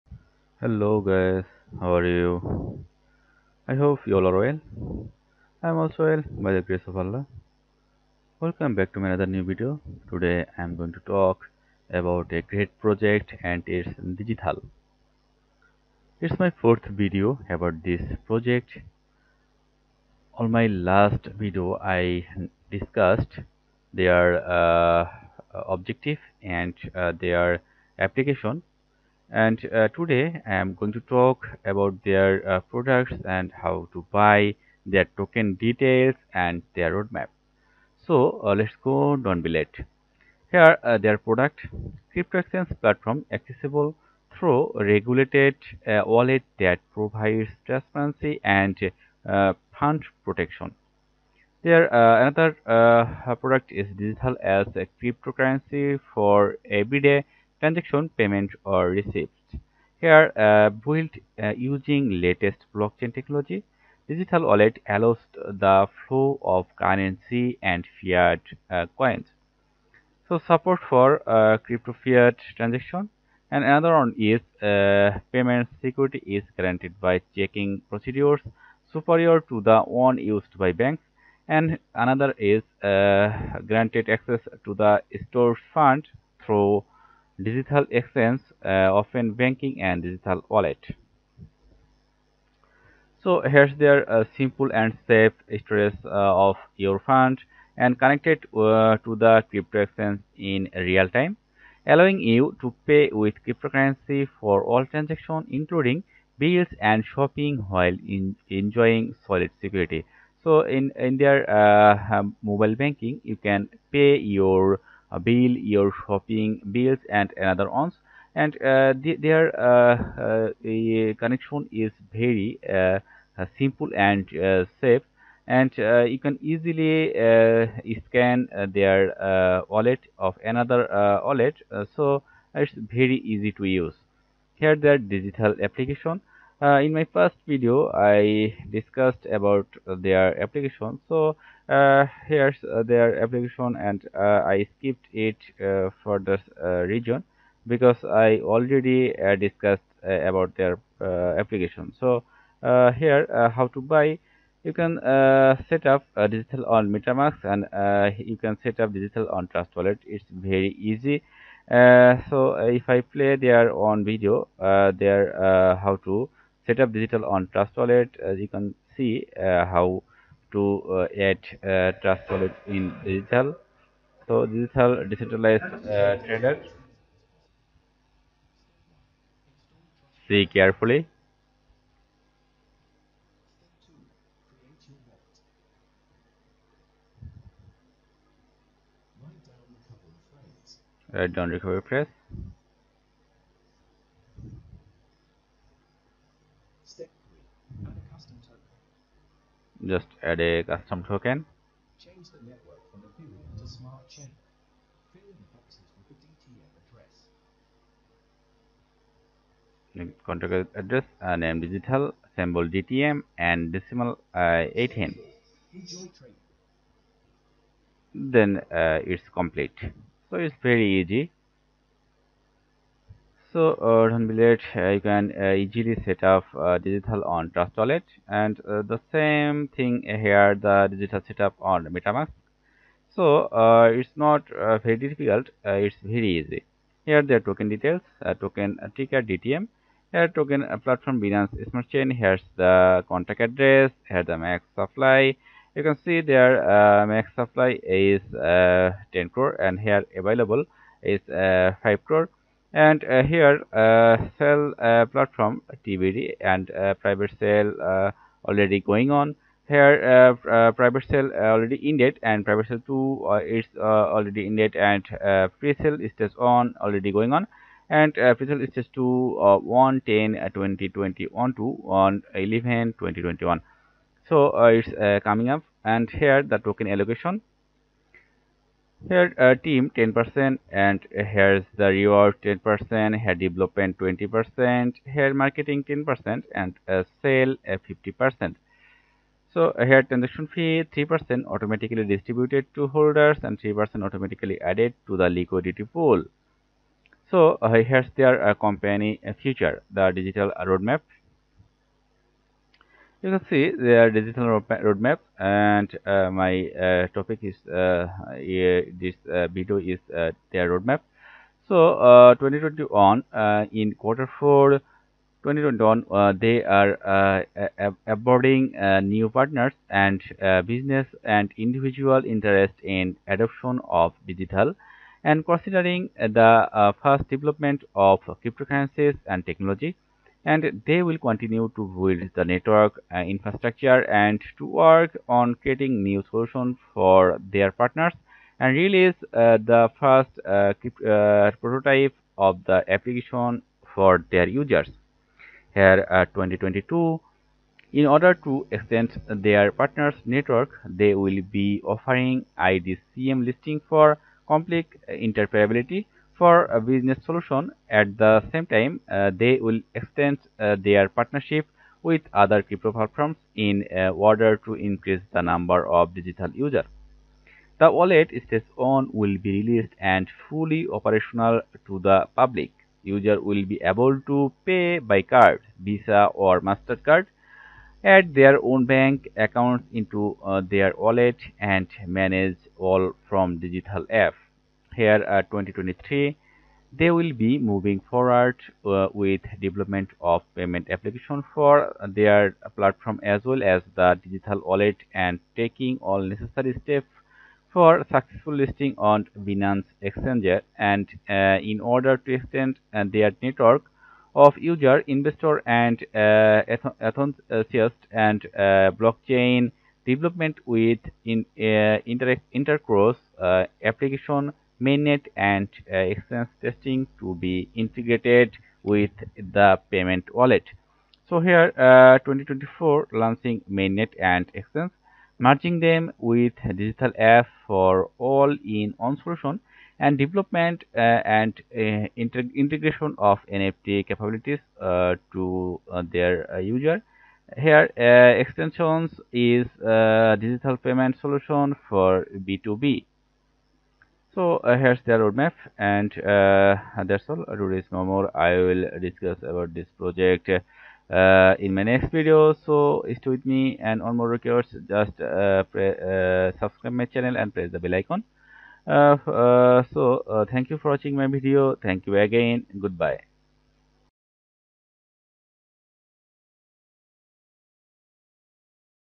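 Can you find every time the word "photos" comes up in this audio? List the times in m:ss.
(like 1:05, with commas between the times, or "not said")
not said.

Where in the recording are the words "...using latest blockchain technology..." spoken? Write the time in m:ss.
1:01.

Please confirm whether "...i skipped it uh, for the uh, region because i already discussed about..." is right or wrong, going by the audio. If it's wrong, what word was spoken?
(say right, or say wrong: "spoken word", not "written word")
right.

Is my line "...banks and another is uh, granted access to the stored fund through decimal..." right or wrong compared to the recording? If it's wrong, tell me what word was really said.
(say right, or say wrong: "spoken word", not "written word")
wrong: "digital", not "decimal".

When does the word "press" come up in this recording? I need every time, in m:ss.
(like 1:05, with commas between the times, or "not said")
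3:11, 7:37.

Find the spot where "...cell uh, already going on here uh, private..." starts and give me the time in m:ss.
4:17.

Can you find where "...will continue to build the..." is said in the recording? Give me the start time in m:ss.
5:31.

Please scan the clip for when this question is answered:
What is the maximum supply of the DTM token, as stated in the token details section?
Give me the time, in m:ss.
4:08.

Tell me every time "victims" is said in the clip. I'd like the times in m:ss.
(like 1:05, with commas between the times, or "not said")
not said.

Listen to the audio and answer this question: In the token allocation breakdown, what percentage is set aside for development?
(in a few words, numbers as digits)
20%.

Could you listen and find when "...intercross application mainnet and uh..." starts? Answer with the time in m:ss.
6:52.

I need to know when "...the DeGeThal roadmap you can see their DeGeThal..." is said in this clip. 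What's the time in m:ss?
4:59.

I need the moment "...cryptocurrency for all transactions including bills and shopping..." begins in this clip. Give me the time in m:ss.
1:43.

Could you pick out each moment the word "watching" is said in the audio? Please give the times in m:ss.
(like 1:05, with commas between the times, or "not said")
7:40.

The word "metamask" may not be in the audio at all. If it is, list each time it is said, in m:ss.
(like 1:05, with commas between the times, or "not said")
2:36, 3:51.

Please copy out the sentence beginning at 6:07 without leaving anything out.
The wallet stage on will be released and fully operational to the public.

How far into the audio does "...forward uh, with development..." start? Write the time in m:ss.
6:28.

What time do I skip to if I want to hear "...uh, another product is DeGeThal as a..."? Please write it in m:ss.
0:51.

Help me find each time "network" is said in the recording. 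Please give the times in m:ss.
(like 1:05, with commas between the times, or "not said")
3:22, 5:32, 5:50, 6:43.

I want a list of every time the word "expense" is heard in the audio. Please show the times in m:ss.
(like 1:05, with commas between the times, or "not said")
7:04.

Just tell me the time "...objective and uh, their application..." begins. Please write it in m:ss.
0:25.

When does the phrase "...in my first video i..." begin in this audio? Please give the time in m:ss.
2:16.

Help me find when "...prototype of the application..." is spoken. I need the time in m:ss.
5:41.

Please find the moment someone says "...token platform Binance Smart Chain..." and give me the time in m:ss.
4:00.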